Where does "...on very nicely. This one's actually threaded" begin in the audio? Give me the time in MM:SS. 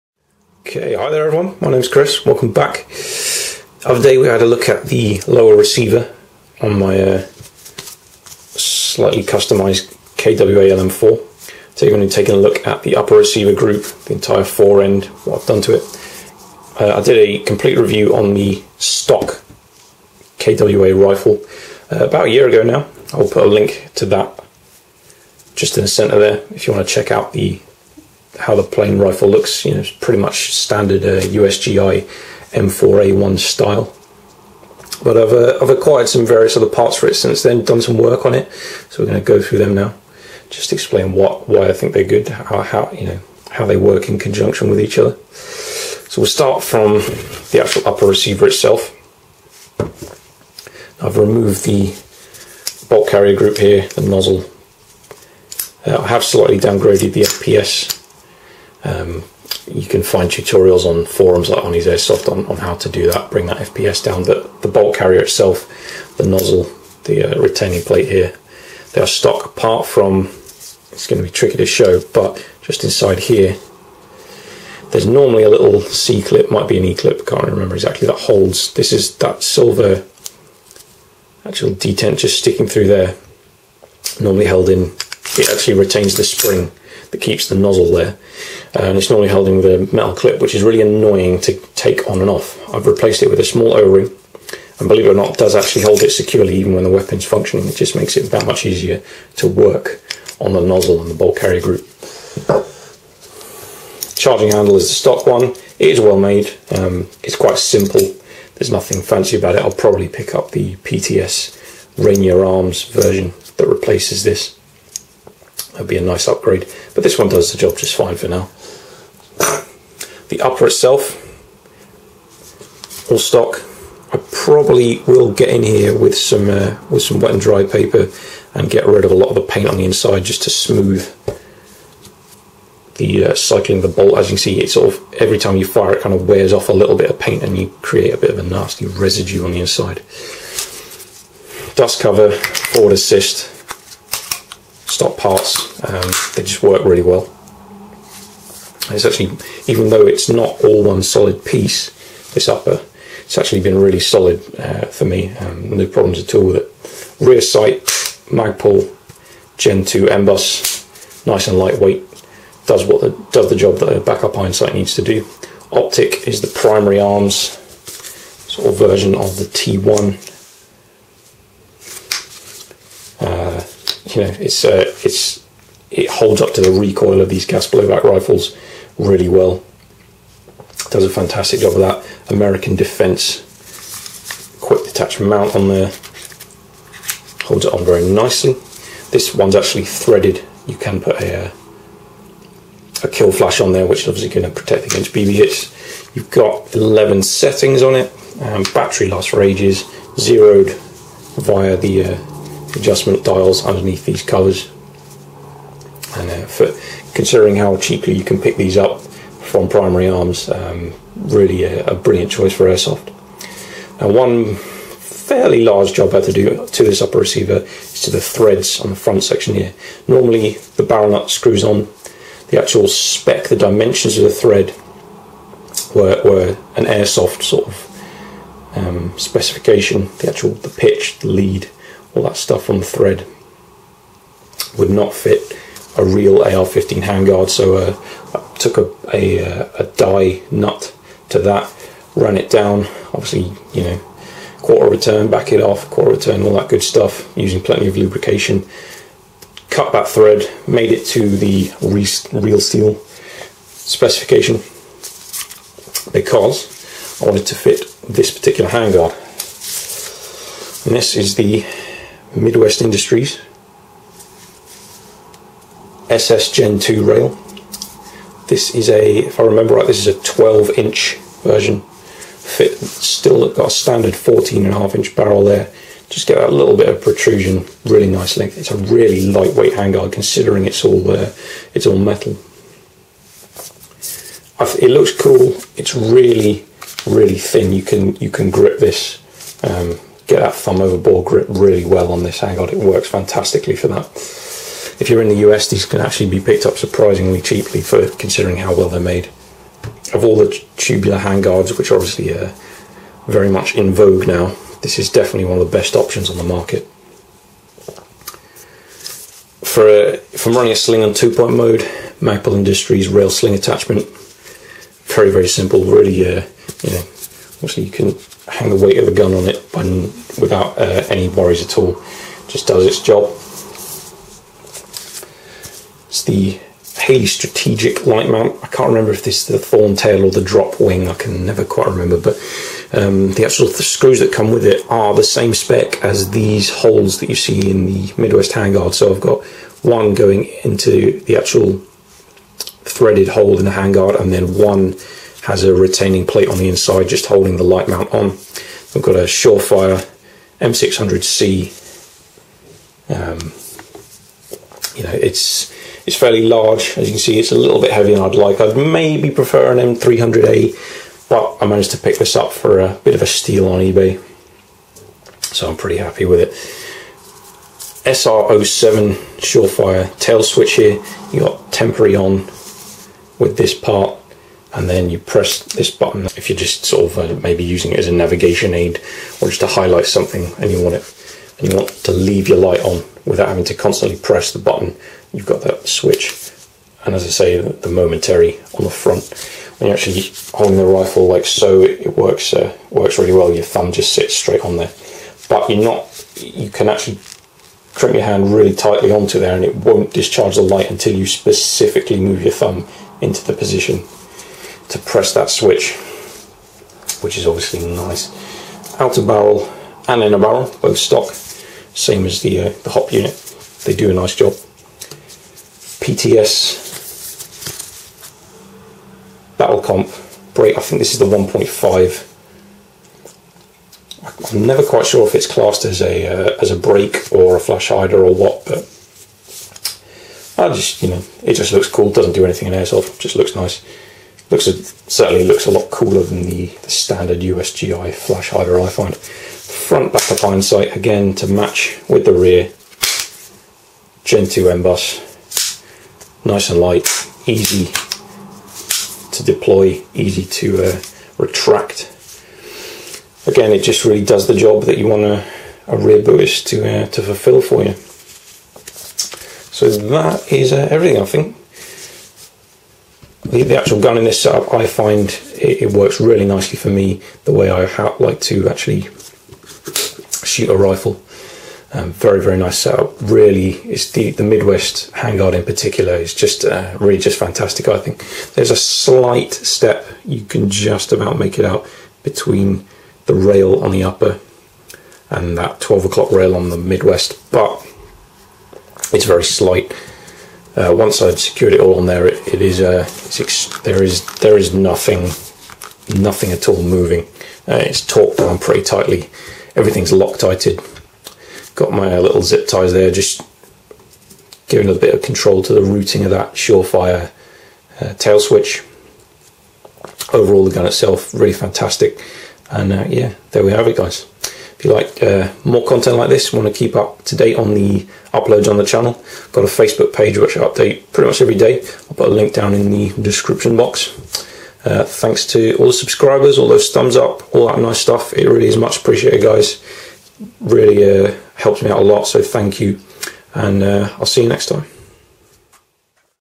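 03:07.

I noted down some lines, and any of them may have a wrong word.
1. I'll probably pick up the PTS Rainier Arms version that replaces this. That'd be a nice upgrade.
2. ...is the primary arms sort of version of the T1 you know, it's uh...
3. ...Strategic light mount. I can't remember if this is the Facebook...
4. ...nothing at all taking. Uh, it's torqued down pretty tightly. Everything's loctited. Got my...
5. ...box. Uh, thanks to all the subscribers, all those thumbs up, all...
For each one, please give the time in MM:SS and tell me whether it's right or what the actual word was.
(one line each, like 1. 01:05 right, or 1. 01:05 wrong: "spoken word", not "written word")
1. 01:49 right
2. 02:46 right
3. 05:27 wrong: "Thorntail", not "Facebook"
4. 08:16 wrong: "moving", not "taking"
5. 08:43 right.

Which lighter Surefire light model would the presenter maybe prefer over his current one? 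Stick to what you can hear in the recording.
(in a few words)
M300A.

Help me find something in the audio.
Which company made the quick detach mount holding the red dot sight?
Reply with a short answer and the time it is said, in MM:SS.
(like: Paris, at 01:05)
American Defense, at 03:02.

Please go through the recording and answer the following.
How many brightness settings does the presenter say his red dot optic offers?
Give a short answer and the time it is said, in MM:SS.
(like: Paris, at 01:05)
11, at 03:16.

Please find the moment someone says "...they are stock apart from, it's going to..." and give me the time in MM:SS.
01:08.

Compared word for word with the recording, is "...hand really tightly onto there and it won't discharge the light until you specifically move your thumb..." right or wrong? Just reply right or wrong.
right.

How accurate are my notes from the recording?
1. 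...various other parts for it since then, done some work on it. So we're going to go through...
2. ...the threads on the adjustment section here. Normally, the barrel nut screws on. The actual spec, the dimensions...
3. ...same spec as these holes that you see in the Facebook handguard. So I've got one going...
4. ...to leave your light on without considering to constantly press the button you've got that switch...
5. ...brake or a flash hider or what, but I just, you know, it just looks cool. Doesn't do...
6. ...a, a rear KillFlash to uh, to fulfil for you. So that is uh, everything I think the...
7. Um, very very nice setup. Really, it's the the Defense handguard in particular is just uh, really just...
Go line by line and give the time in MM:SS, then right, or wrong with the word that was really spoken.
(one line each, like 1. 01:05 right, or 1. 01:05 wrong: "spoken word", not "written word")
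1. 00:36 right
2. 03:38 wrong: "front", not "adjustment"
3. 05:35 wrong: "Midwest", not "Facebook"
4. 06:21 wrong: "having", not "considering"
5. 07:06 right
6. 07:35 wrong: "BUIS", not "KillFlash"
7. 07:51 wrong: "Midwest", not "Defense".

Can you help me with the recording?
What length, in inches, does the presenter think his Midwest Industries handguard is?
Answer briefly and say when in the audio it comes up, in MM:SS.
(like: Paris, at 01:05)
12 inch, at 04:30.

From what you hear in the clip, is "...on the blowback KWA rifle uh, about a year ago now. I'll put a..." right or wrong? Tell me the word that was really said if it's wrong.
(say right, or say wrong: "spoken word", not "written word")
wrong: "stock", not "blowback".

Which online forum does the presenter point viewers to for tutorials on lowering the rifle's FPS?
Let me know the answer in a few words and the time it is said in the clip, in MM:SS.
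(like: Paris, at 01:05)
Arnie's Airsoft, at 01:01.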